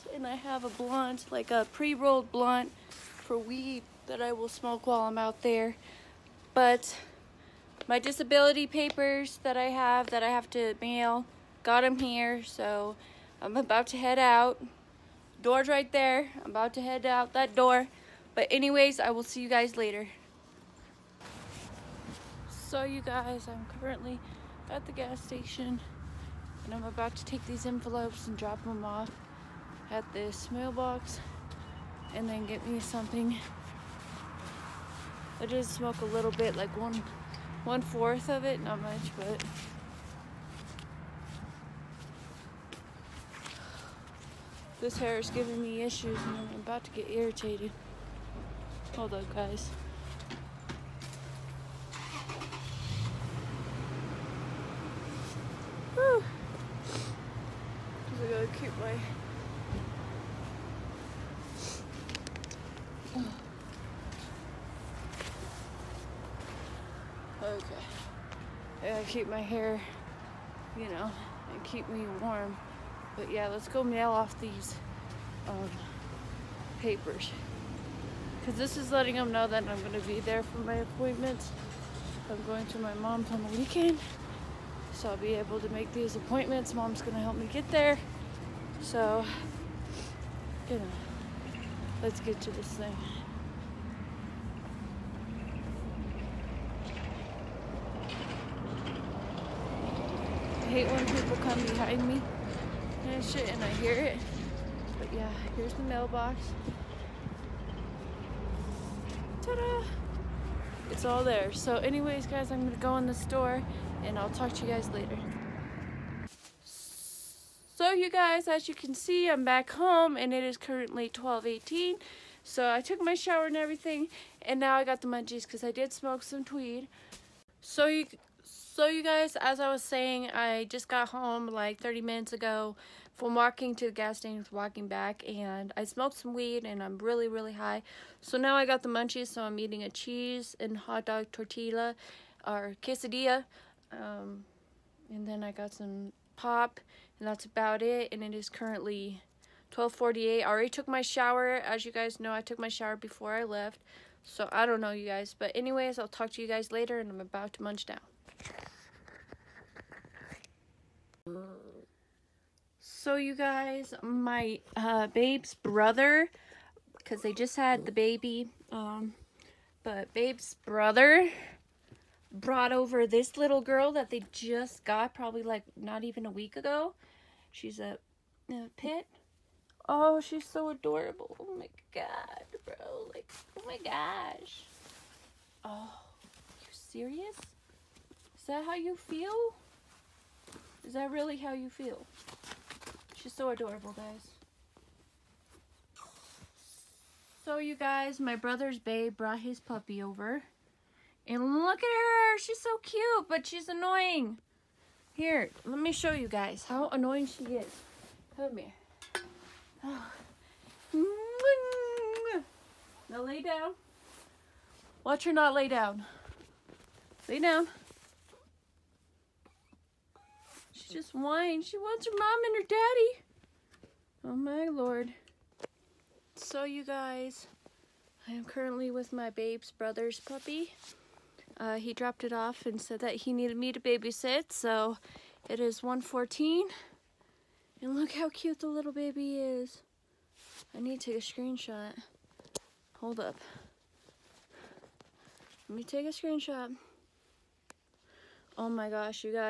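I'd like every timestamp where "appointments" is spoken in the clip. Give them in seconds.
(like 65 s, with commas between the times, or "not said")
80 s, 86 s.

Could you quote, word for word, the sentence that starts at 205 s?
Here, let me show you guys how annoying she is.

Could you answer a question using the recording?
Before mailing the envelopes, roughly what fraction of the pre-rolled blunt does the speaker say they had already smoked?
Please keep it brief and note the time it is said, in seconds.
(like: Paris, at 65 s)
1/4, at 36 s.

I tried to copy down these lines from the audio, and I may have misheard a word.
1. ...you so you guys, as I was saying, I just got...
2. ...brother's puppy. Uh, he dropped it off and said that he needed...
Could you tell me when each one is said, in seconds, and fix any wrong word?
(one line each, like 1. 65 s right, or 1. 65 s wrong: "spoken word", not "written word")
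1. 127 s right
2. 229 s right.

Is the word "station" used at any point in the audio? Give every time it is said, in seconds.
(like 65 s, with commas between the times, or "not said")
25 s, 134 s.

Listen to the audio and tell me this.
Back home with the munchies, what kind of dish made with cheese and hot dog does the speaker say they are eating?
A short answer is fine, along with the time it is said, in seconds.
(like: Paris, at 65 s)
quesadilla, at 142 s.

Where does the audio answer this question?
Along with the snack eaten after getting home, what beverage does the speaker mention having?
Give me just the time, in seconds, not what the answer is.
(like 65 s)
146 s.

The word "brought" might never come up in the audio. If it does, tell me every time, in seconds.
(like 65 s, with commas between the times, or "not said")
172 s, 199 s.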